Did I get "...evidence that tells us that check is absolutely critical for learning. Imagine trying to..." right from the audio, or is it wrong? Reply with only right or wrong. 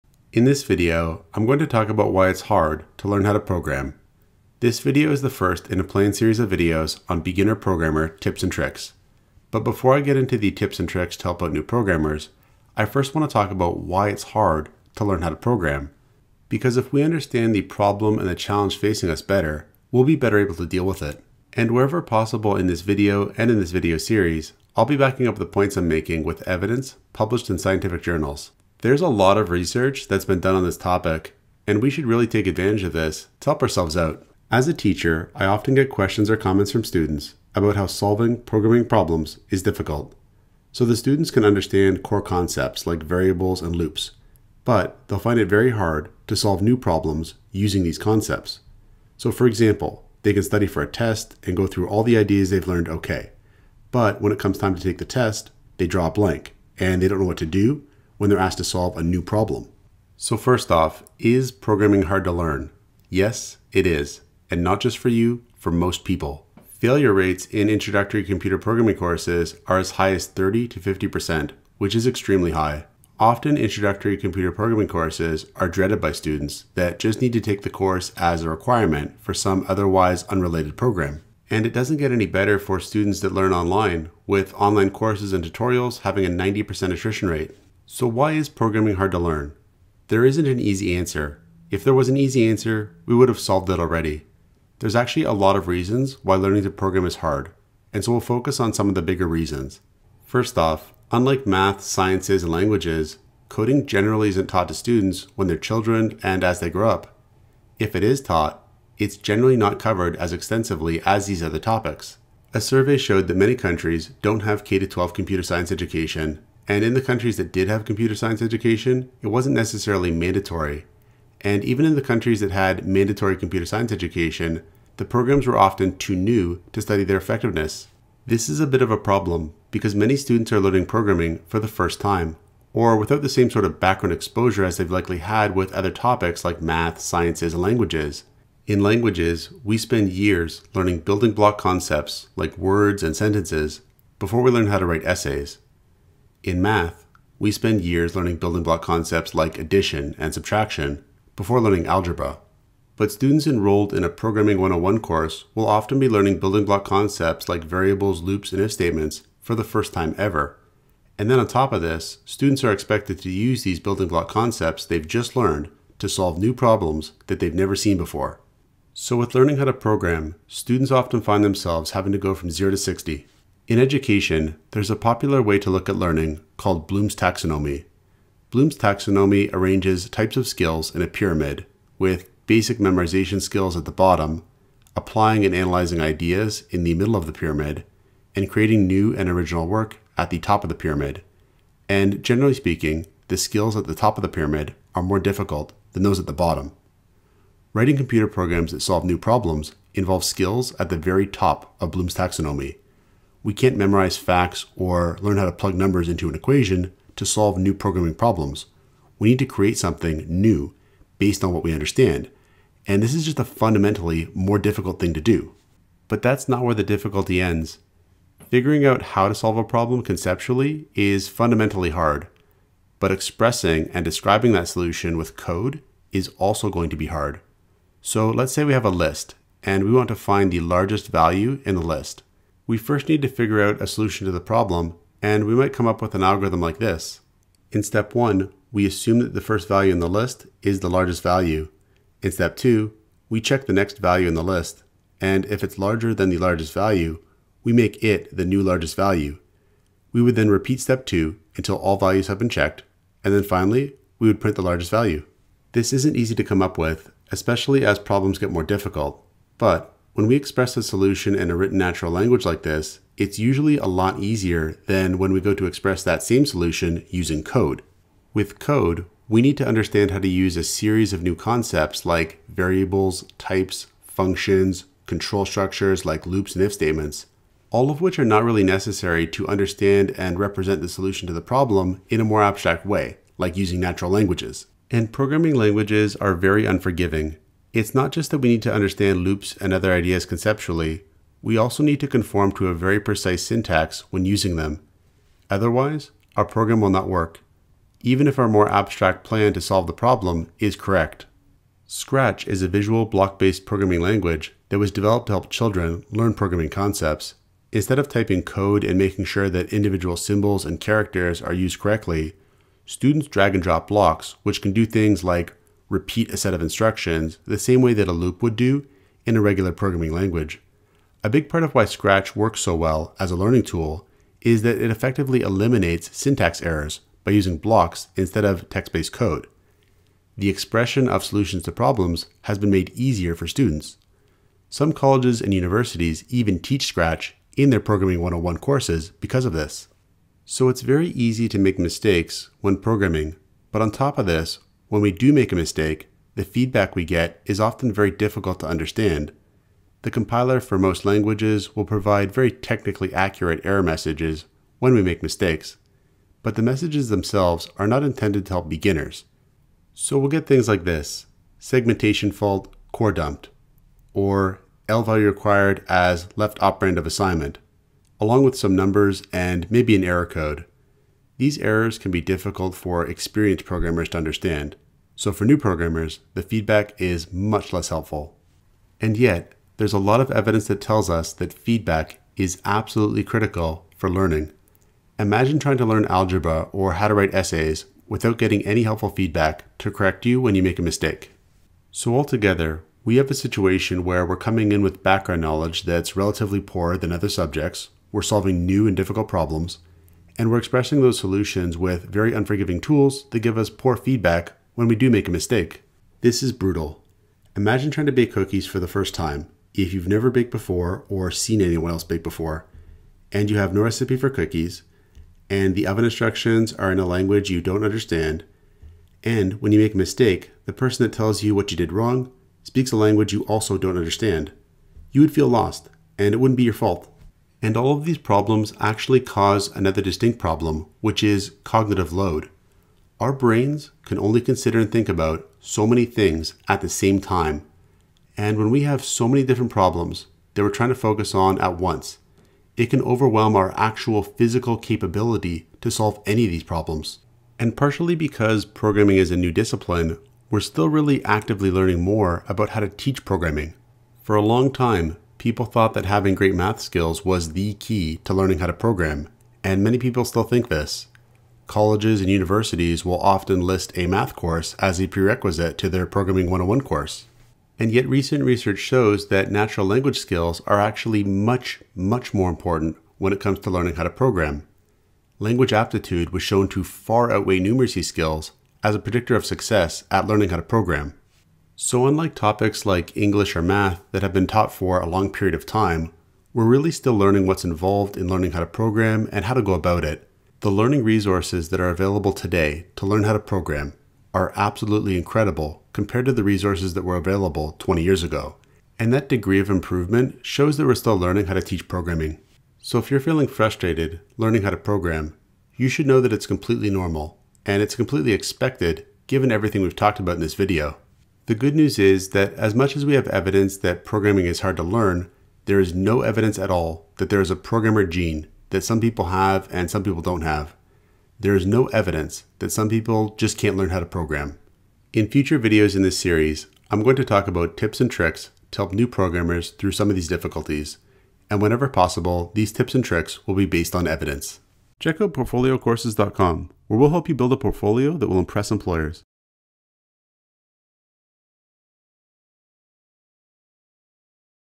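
wrong.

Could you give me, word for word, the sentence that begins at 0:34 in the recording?
As a teacher, I often get questions or comments from students about how solving programming problems is difficult.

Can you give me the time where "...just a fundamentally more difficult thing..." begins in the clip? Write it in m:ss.
3:33.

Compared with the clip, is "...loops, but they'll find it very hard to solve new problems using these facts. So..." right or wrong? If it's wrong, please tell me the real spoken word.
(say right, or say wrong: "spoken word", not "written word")
wrong: "concepts", not "facts".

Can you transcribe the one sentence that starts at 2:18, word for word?
In languages, we spend years learning building block concepts like words and sentences before we learn how to write essays.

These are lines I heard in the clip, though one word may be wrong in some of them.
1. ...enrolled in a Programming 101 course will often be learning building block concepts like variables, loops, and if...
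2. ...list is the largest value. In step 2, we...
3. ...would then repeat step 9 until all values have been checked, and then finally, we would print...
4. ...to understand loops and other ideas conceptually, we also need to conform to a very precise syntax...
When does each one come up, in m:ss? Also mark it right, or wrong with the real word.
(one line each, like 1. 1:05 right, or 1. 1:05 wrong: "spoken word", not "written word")
1. 2:33 right
2. 4:00 right
3. 4:10 wrong: "2", not "9"
4. 4:48 right.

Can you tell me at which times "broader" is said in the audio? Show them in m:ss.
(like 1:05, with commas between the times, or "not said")
not said.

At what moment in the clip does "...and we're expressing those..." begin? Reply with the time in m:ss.
6:40.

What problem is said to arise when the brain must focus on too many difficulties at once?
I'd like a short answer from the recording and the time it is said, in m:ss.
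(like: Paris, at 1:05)
cognitive load, at 7:11.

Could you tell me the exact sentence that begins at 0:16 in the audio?
Because if we understand the problem and the challenge facing us better, we'll be better able to deal with it.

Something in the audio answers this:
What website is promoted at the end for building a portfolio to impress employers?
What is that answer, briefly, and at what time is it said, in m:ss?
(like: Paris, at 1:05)
portfoliocourses.com, at 8:55.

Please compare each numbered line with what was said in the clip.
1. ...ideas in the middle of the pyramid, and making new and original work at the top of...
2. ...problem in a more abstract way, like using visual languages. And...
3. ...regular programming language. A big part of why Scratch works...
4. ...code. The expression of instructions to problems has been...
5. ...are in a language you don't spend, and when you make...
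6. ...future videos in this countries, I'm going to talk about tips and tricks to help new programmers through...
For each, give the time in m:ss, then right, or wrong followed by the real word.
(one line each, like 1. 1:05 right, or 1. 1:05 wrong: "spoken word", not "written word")
1. 3:06 wrong: "creating", not "making"
2. 4:41 wrong: "natural", not "visual"
3. 5:19 right
4. 5:29 wrong: "solutions", not "instructions"
5. 6:56 wrong: "understand", not "spend"
6. 8:45 wrong: "series", not "countries".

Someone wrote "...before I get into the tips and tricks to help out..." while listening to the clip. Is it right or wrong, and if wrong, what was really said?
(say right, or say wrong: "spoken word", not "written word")
right.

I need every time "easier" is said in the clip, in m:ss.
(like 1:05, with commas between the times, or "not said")
4:24, 5:32.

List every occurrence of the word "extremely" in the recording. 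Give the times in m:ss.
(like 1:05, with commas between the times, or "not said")
1:12.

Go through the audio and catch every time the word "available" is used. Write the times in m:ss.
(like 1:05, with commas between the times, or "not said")
8:11, 8:17.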